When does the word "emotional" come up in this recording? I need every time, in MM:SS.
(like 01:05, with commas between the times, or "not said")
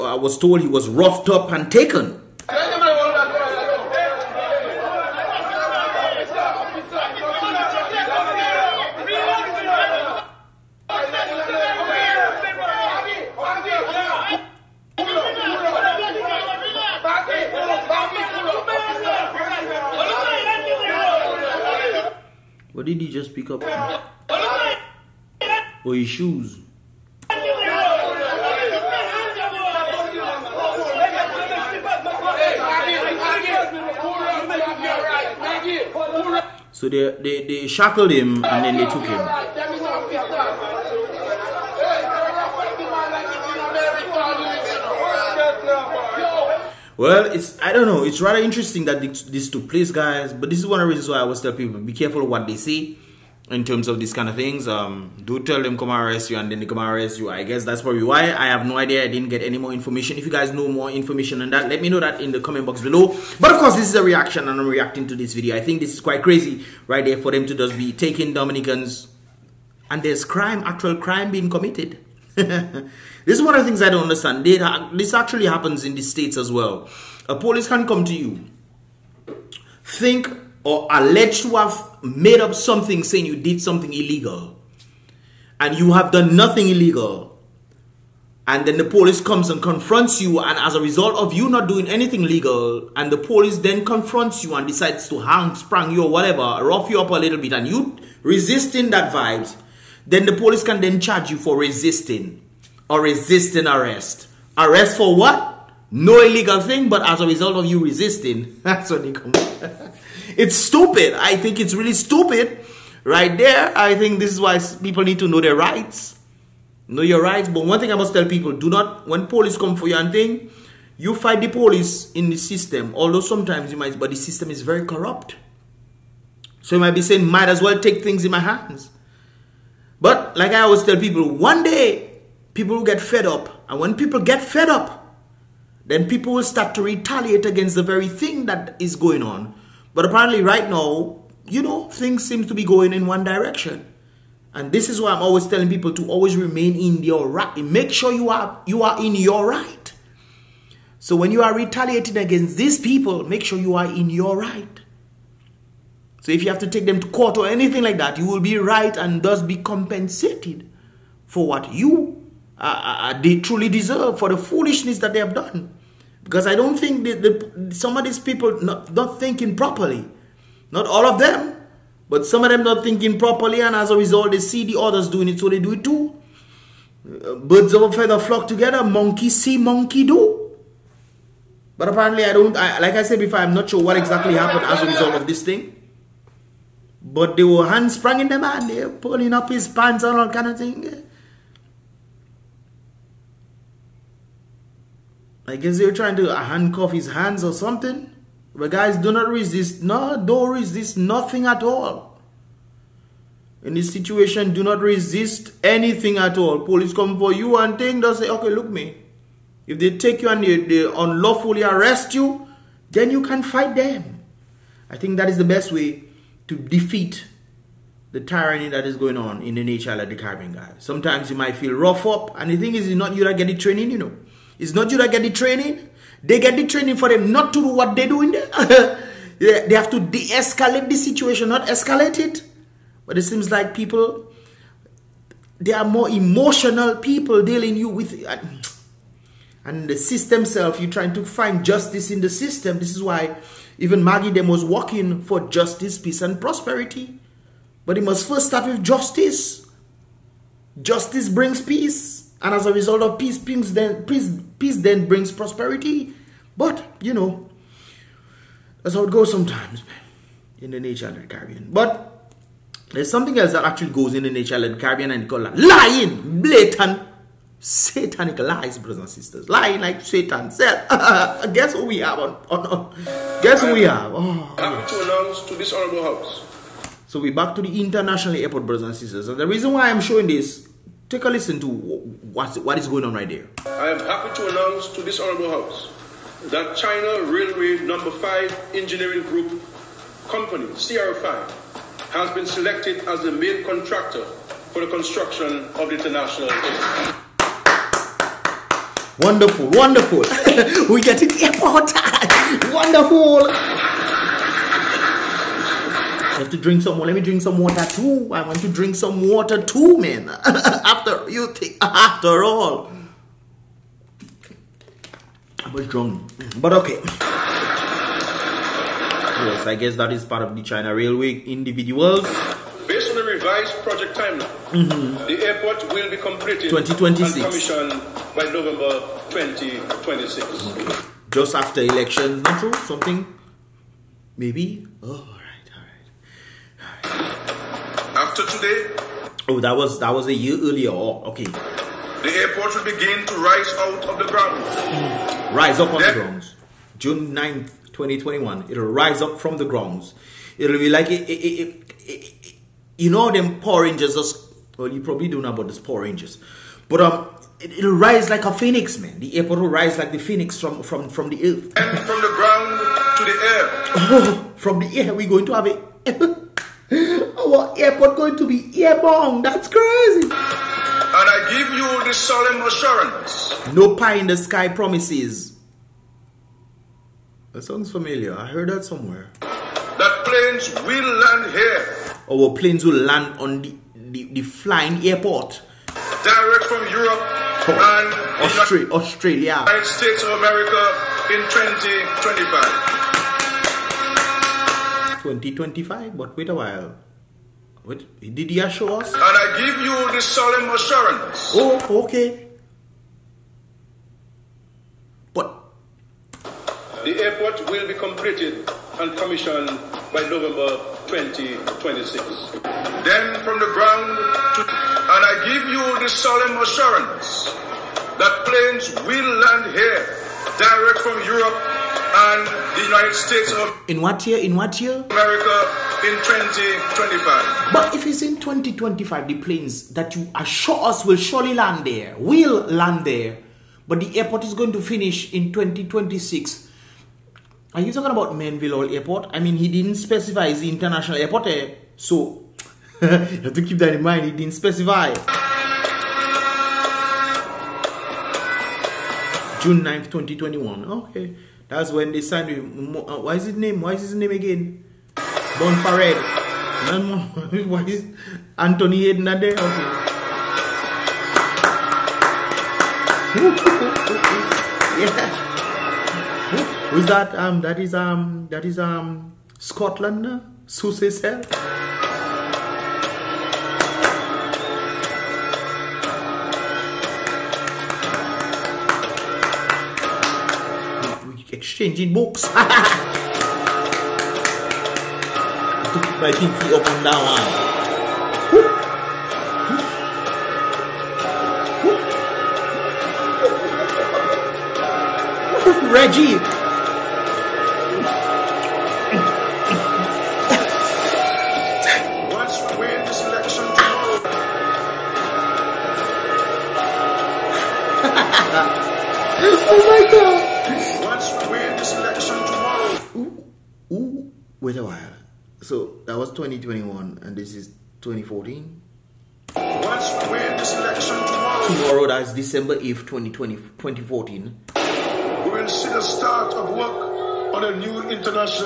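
03:56.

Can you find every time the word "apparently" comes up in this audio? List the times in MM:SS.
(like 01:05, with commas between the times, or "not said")
02:20, 03:01.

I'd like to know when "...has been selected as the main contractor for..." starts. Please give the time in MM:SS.
04:52.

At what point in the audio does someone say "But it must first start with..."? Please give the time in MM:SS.
04:07.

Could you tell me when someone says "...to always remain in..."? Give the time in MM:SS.
02:25.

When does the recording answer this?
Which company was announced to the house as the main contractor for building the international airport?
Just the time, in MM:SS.
04:46.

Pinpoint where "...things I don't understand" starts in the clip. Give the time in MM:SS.
01:13.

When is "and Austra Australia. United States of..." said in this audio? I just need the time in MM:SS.
06:28.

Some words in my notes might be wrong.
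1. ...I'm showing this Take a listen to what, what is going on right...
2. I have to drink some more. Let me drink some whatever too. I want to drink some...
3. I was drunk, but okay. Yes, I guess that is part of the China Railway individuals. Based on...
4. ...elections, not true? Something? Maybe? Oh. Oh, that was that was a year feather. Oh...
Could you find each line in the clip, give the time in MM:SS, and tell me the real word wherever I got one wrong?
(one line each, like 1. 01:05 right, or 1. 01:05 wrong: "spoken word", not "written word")
1. 04:39 right
2. 05:06 wrong: "water", not "whatever"
3. 05:15 right
4. 05:31 wrong: "earlier", not "feather".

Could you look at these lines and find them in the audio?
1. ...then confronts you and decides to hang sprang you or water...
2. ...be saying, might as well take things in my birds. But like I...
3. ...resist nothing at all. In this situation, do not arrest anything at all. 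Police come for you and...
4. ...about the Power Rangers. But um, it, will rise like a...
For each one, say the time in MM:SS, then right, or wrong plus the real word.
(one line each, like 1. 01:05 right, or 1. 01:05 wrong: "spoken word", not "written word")
1. 01:33 wrong: "whatever", not "water"
2. 02:06 wrong: "hands", not "birds"
3. 03:20 wrong: "resist", not "arrest"
4. 05:55 right.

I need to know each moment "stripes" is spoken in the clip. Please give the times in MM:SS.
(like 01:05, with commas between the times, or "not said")
not said.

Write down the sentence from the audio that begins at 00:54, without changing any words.
Um, do tell them come arrest you and then they come arrest you.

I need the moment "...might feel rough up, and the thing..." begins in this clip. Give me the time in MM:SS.
03:41.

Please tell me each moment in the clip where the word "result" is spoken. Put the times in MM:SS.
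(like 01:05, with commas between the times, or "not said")
01:30, 01:47, 02:53, 03:04, 04:12.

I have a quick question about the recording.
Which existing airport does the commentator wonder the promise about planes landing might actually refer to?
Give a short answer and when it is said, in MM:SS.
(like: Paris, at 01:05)
Melville Airport, at 07:18.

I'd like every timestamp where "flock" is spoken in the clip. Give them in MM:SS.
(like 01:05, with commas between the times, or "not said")
02:58.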